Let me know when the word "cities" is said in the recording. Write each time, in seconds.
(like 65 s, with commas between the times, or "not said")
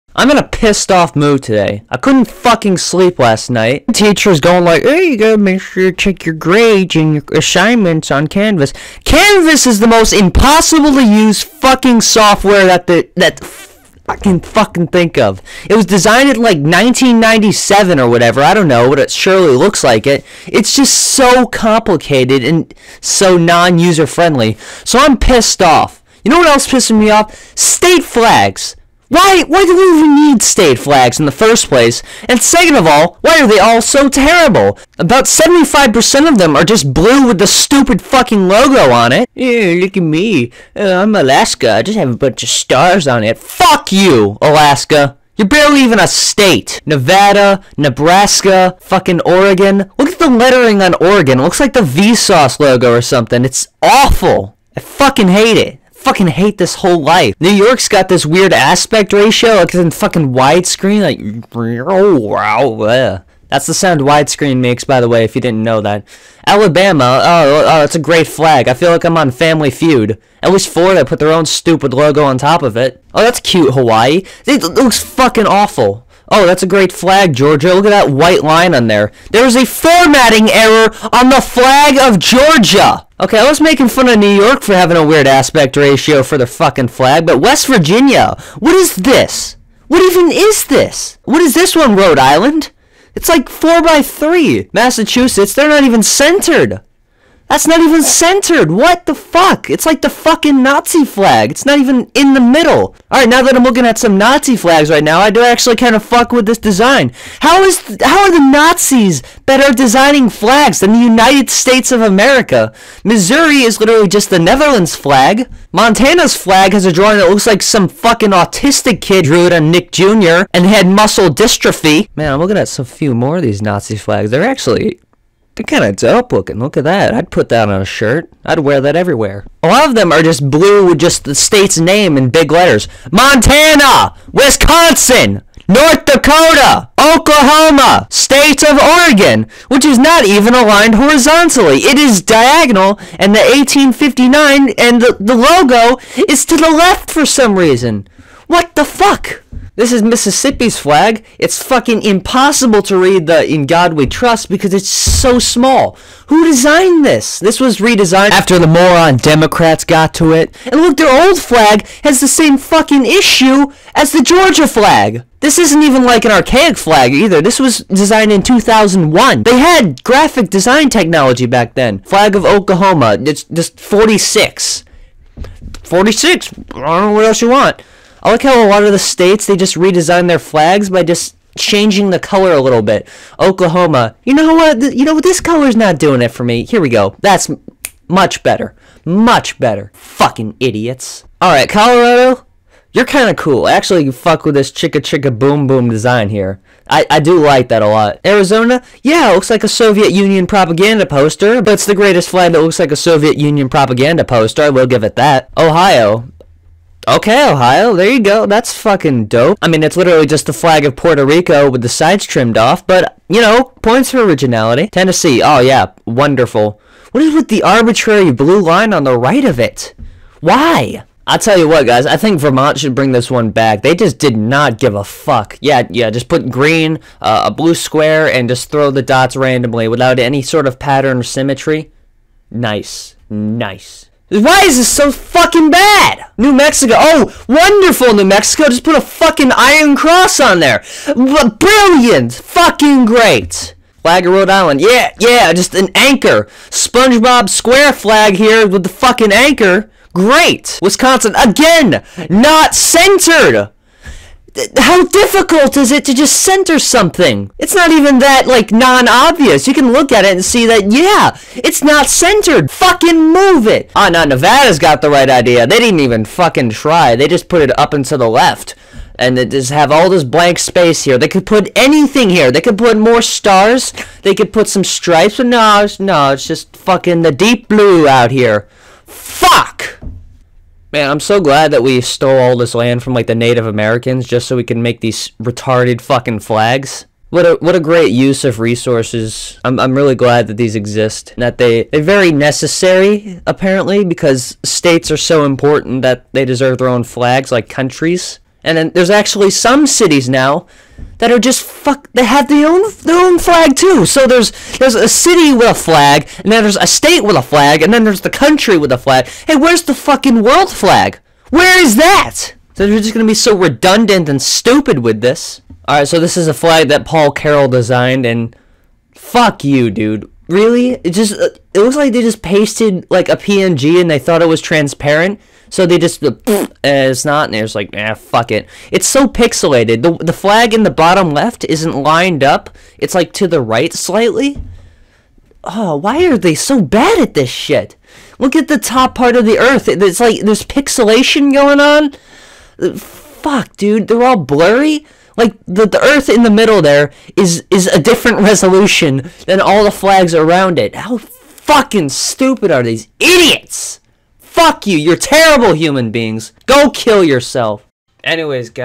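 299 s.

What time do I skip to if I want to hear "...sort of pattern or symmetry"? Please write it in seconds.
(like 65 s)
230 s.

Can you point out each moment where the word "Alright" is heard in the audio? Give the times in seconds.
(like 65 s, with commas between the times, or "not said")
103 s.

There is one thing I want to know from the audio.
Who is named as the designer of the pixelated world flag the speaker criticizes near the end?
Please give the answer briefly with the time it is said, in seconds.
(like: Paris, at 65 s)
Paul Carroll, at 317 s.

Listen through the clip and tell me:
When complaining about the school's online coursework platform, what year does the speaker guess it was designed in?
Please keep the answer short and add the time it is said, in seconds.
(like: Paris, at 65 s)
1997, at 16 s.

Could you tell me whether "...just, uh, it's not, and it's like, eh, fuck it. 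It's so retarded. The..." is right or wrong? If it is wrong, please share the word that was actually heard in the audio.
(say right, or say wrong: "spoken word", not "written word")
wrong: "pixelated", not "retarded".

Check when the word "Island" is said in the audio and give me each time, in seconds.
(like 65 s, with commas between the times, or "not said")
92 s, 244 s.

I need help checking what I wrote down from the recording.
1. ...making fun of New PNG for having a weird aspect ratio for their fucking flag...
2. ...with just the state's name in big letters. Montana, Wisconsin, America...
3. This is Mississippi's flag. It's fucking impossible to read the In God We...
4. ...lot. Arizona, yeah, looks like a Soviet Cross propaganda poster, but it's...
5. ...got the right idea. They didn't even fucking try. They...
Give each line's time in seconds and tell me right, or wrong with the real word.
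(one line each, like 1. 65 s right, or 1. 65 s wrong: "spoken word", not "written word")
1. 83 s wrong: "York", not "PNG"
2. 130 s wrong: "North", not "America"
3. 149 s right
4. 197 s wrong: "Union", not "Cross"
5. 264 s right.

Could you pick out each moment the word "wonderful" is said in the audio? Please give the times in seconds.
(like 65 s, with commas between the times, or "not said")
216 s, 237 s.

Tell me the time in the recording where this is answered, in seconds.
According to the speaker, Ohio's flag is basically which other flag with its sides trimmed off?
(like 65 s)
210 s.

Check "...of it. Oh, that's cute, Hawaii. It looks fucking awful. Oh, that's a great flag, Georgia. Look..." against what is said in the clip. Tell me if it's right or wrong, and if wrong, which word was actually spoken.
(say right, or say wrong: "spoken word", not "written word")
right.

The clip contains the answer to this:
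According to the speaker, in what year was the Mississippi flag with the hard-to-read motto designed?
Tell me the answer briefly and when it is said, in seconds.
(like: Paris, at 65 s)
2001, at 168 s.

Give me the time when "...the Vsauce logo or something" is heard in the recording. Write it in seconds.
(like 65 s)
51 s.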